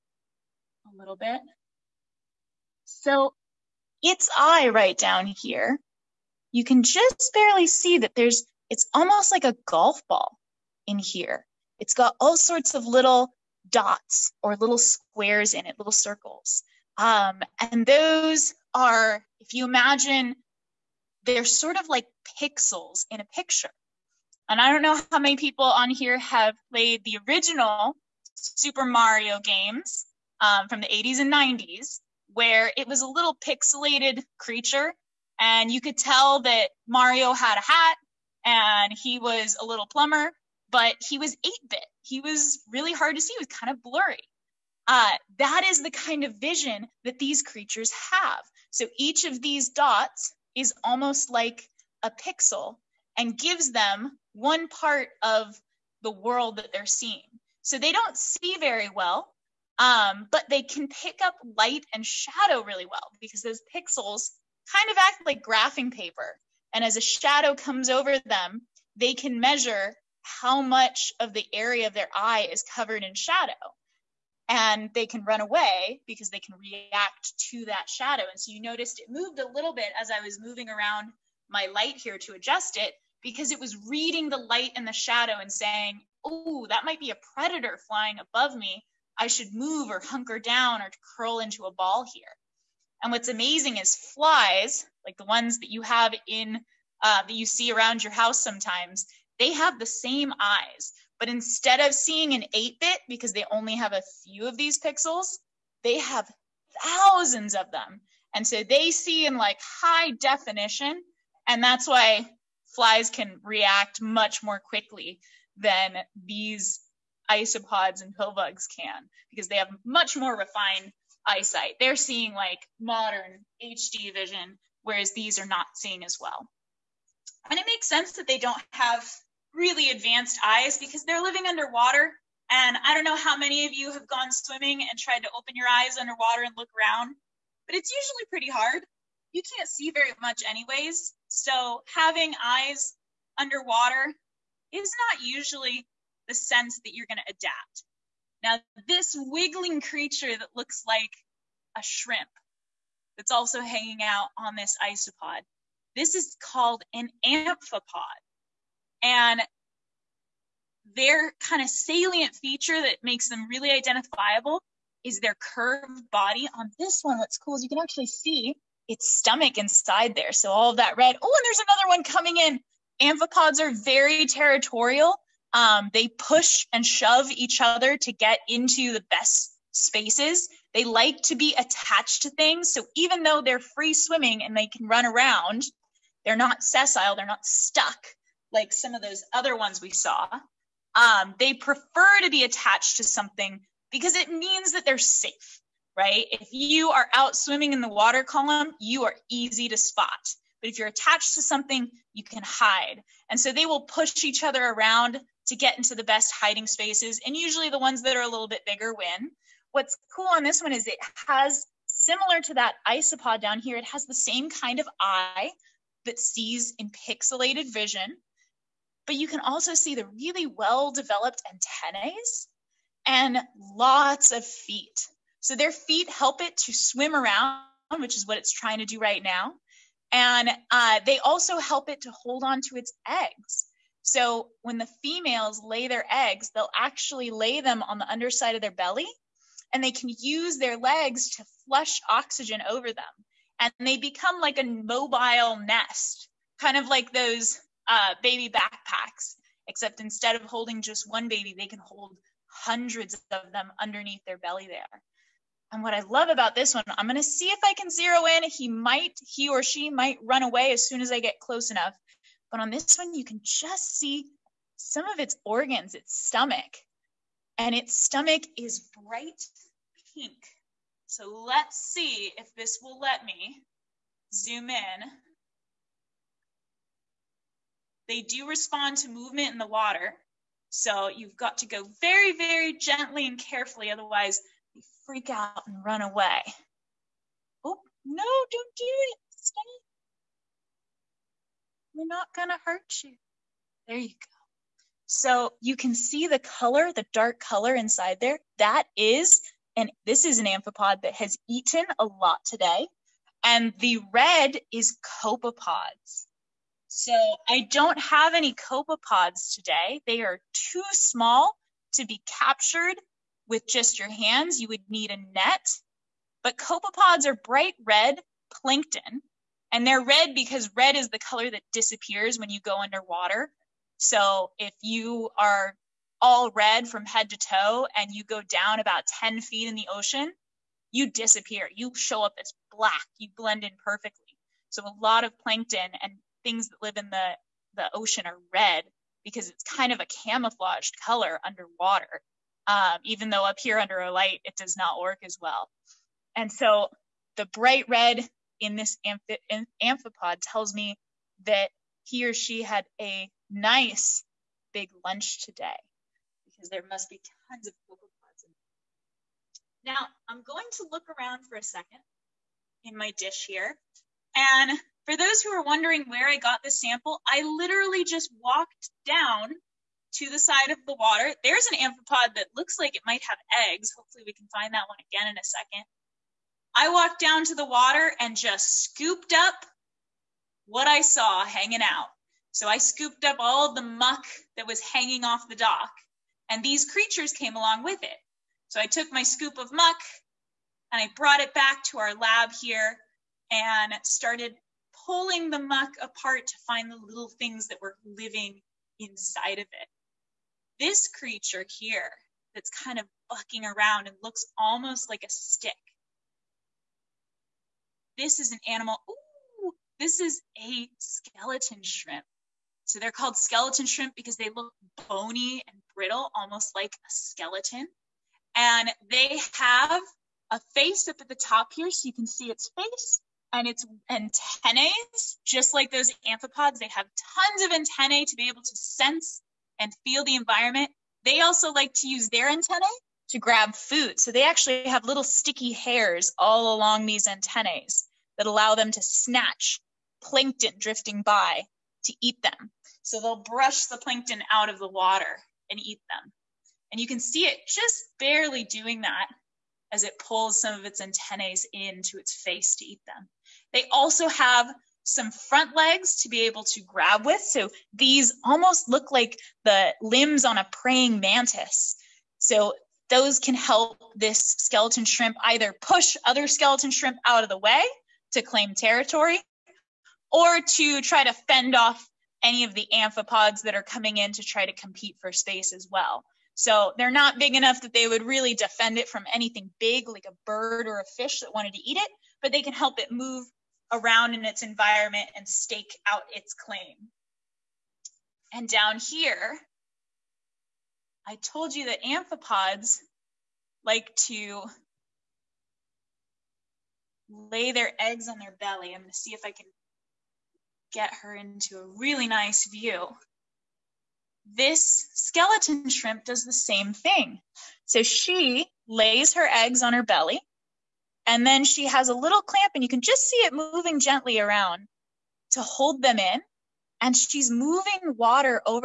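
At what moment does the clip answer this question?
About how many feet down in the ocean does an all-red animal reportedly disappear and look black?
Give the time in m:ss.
5:29.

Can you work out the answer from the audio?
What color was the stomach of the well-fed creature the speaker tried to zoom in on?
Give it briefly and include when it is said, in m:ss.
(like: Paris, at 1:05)
Bright pink, at 4:29.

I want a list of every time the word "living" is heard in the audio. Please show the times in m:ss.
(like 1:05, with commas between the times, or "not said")
2:11, 6:38.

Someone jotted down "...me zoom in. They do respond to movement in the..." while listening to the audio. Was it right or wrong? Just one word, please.
right.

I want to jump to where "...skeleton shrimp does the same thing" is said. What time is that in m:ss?
8:25.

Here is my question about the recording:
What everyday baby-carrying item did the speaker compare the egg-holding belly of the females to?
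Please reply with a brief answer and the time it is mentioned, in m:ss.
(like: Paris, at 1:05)
Baby backpacks, at 4:08.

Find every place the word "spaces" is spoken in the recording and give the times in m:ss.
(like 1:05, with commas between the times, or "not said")
2:59, 3:26, 7:55.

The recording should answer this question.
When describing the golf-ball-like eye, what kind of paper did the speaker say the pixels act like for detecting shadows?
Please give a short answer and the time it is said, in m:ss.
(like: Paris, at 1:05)
Graphing paper, at 1:05.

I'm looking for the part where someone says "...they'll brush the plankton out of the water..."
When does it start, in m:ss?
7:23.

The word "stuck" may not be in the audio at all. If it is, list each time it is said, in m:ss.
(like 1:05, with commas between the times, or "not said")
3:07.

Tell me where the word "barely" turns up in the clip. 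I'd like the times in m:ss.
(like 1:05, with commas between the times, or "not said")
0:07, 7:28.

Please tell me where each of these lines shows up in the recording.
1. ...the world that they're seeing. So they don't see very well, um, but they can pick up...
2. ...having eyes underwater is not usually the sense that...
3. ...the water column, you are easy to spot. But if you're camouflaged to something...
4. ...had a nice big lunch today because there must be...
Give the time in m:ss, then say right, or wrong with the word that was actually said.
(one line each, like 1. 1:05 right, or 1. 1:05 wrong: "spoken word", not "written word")
1. 0:56 right
2. 2:21 right
3. 3:17 wrong: "attached", not "camouflaged"
4. 5:52 right.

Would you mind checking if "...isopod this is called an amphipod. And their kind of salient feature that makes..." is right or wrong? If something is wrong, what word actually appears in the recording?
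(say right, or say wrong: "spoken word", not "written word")
right.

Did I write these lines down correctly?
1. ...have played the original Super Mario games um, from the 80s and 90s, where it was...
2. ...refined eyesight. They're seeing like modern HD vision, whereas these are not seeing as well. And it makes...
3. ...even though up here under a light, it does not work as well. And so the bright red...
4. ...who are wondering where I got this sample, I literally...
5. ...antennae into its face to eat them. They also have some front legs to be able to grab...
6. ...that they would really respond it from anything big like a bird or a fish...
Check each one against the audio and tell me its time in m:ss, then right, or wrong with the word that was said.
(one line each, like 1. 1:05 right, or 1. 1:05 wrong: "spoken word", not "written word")
1. 0:26 right
2. 2:00 right
3. 5:43 right
4. 6:05 right
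5. 7:31 right
6. 7:57 wrong: "defend", not "respond".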